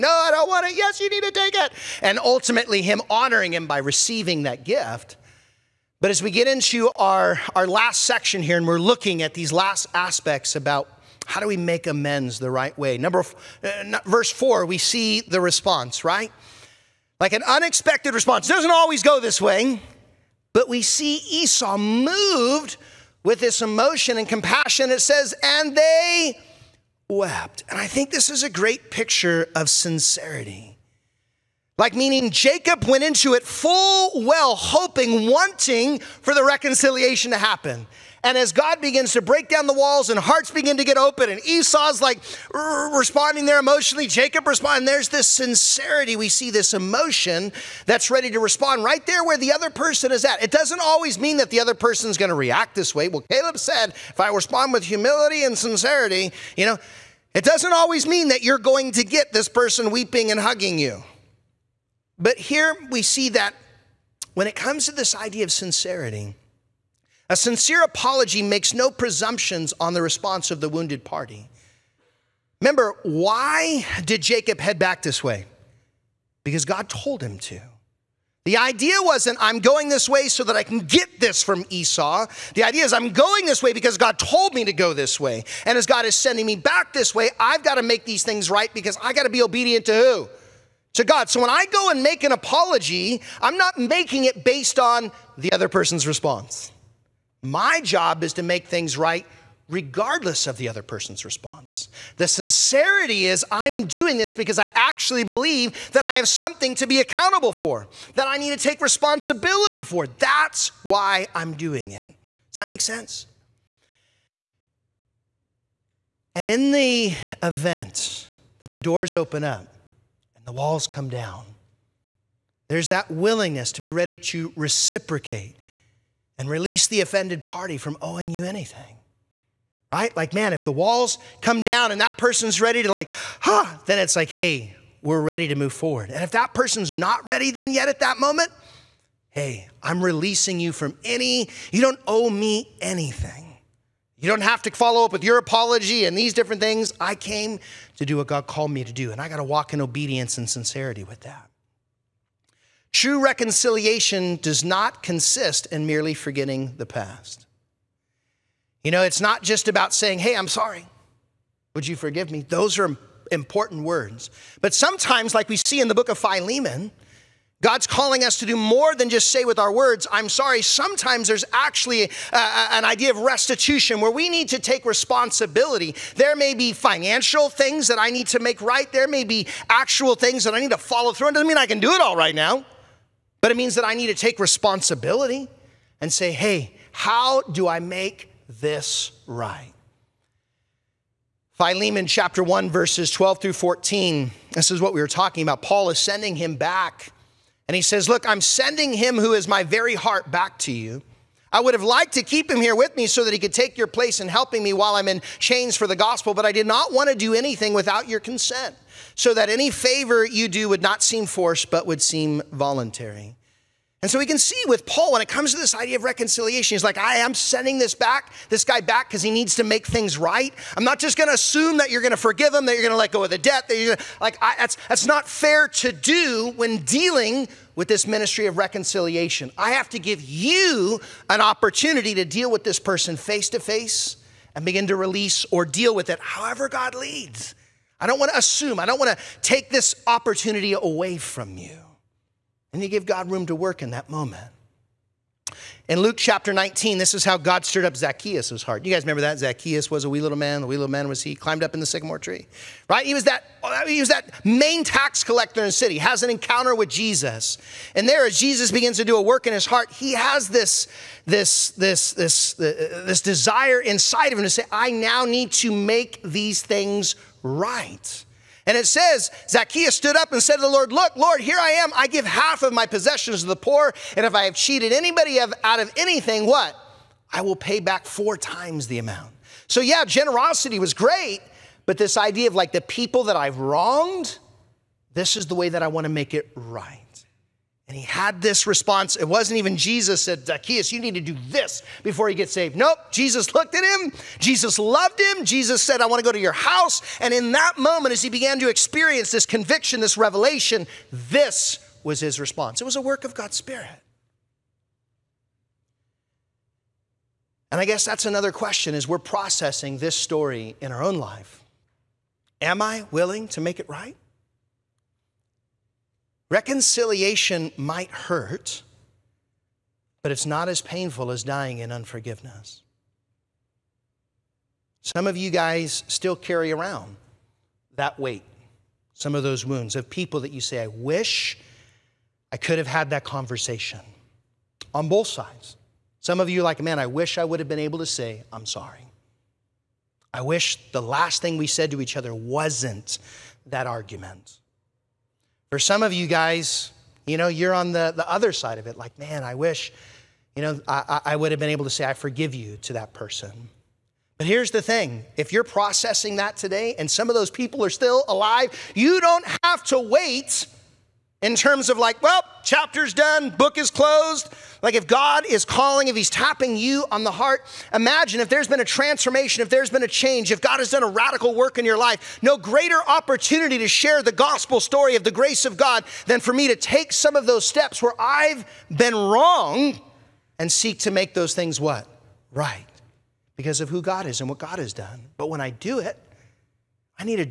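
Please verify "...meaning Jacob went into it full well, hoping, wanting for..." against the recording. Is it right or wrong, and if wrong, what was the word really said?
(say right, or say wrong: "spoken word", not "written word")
right.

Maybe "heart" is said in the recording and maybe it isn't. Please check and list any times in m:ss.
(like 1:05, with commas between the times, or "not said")
0:40, 3:19, 4:08, 4:19, 6:07.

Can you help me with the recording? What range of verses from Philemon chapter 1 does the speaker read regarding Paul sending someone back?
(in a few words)
12 through 14.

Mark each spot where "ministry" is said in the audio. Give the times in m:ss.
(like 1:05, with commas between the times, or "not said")
3:48.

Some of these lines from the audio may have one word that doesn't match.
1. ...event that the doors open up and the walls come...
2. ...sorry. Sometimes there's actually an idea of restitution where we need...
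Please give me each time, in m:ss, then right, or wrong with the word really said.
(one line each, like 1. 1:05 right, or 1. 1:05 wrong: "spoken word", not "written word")
1. 1:57 right
2. 2:50 right.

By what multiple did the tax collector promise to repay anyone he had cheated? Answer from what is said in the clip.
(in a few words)
4 times.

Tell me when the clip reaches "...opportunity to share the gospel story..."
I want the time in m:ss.
6:13.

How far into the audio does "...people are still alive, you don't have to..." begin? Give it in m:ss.
5:57.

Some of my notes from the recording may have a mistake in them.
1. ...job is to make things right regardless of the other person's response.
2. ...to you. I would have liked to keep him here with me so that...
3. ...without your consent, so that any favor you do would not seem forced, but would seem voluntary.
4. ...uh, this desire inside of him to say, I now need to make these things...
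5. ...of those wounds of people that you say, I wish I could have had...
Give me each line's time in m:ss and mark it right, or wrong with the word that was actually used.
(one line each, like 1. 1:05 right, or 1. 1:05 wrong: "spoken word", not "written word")
1. 1:37 right
2. 3:20 right
3. 3:27 right
4. 4:22 right
5. 5:29 right.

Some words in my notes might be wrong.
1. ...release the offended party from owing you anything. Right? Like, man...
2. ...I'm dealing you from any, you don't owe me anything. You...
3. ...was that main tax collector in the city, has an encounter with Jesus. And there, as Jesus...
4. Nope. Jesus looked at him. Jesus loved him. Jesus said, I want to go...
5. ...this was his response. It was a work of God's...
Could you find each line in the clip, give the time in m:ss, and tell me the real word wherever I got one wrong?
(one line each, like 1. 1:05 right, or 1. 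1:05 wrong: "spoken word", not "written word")
1. 2:06 right
2. 2:19 wrong: "releasing", not "dealing"
3. 4:13 right
4. 4:52 right
5. 5:01 right.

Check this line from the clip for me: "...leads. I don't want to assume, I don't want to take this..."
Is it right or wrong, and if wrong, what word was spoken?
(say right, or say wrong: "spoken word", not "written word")
right.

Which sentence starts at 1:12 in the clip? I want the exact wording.
Remember, why did Jacob head back this way?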